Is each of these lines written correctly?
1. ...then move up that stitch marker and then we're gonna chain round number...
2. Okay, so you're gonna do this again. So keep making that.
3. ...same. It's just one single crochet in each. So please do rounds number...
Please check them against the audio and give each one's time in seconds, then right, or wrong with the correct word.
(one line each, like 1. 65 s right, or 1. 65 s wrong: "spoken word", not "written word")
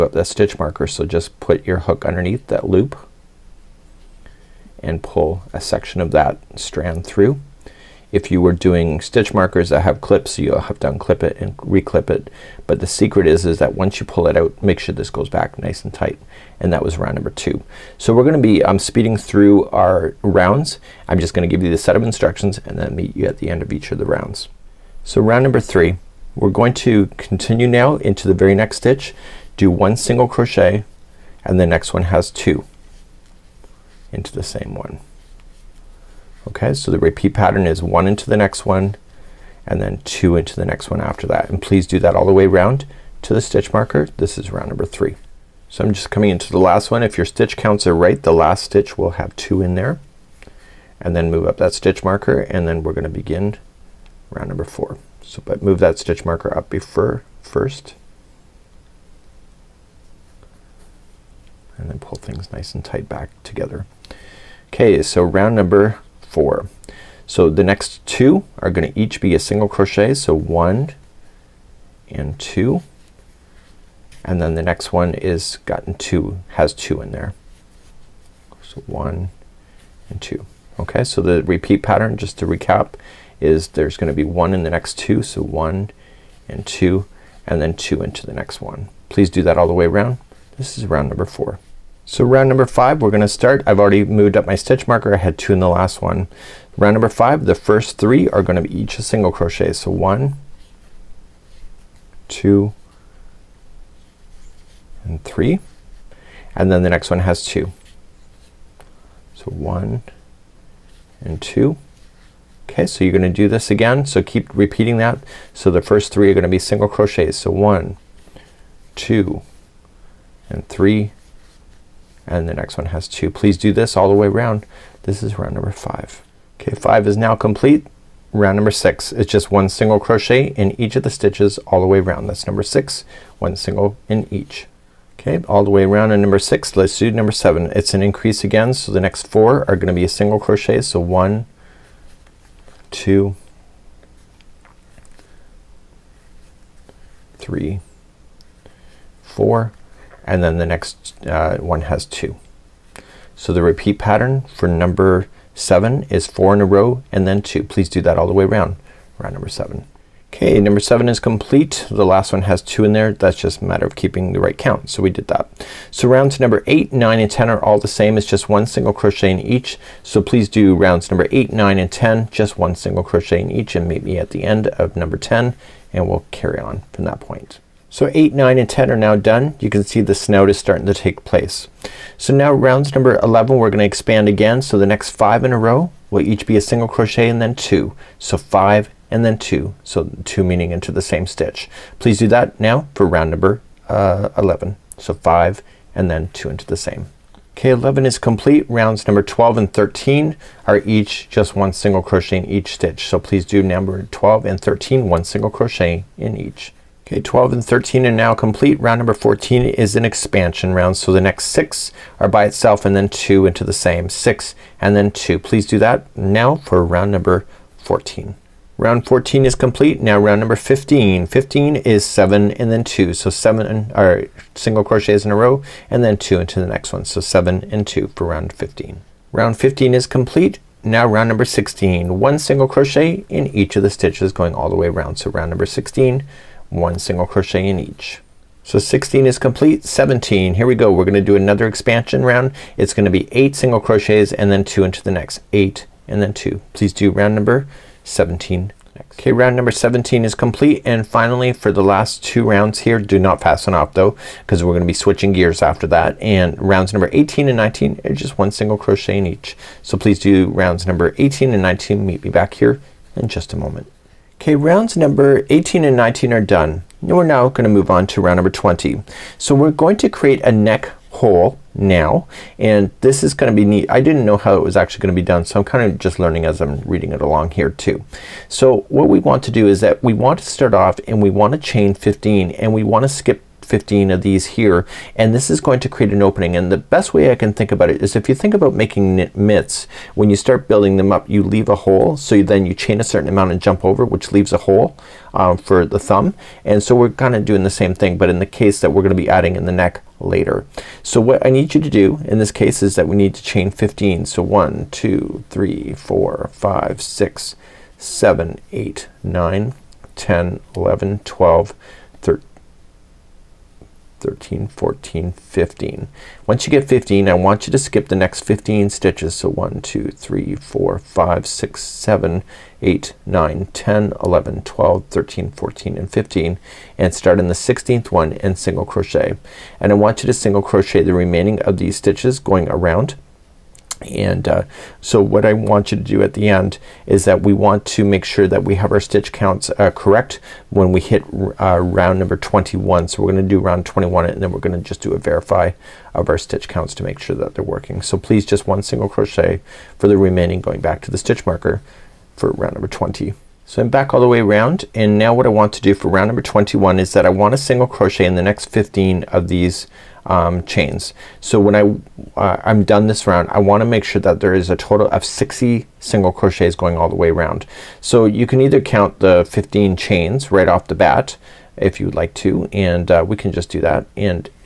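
1. 51 s wrong: "begin", not "chain"
2. 112 s wrong: "repeating", not "making"
3. 167 s right.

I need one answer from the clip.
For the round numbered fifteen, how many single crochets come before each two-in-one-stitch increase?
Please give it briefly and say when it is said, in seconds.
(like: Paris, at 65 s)
7, at 222 s.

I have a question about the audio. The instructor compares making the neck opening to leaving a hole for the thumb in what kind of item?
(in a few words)
knit mitts.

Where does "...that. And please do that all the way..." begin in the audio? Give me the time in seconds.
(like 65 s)
41 s.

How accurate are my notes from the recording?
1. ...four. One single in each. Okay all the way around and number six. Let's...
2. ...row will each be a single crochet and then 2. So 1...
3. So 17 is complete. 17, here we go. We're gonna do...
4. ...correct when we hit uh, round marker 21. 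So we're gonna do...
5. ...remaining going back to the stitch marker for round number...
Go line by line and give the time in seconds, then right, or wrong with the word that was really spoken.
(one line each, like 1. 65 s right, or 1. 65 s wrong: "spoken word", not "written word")
1. 132 s wrong: "six", not "four"
2. 185 s wrong: "5", not "1"
3. 238 s wrong: "16", not "17"
4. 339 s wrong: "number", not "marker"
5. 350 s right.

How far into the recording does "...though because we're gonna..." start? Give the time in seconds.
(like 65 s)
253 s.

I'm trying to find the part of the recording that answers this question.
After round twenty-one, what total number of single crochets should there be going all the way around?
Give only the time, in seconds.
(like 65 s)
365 s.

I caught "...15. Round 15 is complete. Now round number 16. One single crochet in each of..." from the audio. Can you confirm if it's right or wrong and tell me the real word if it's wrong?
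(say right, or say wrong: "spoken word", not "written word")
right.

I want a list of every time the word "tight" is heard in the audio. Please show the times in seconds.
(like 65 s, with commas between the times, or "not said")
15 s, 62 s.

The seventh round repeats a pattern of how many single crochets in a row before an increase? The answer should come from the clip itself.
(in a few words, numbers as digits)
4.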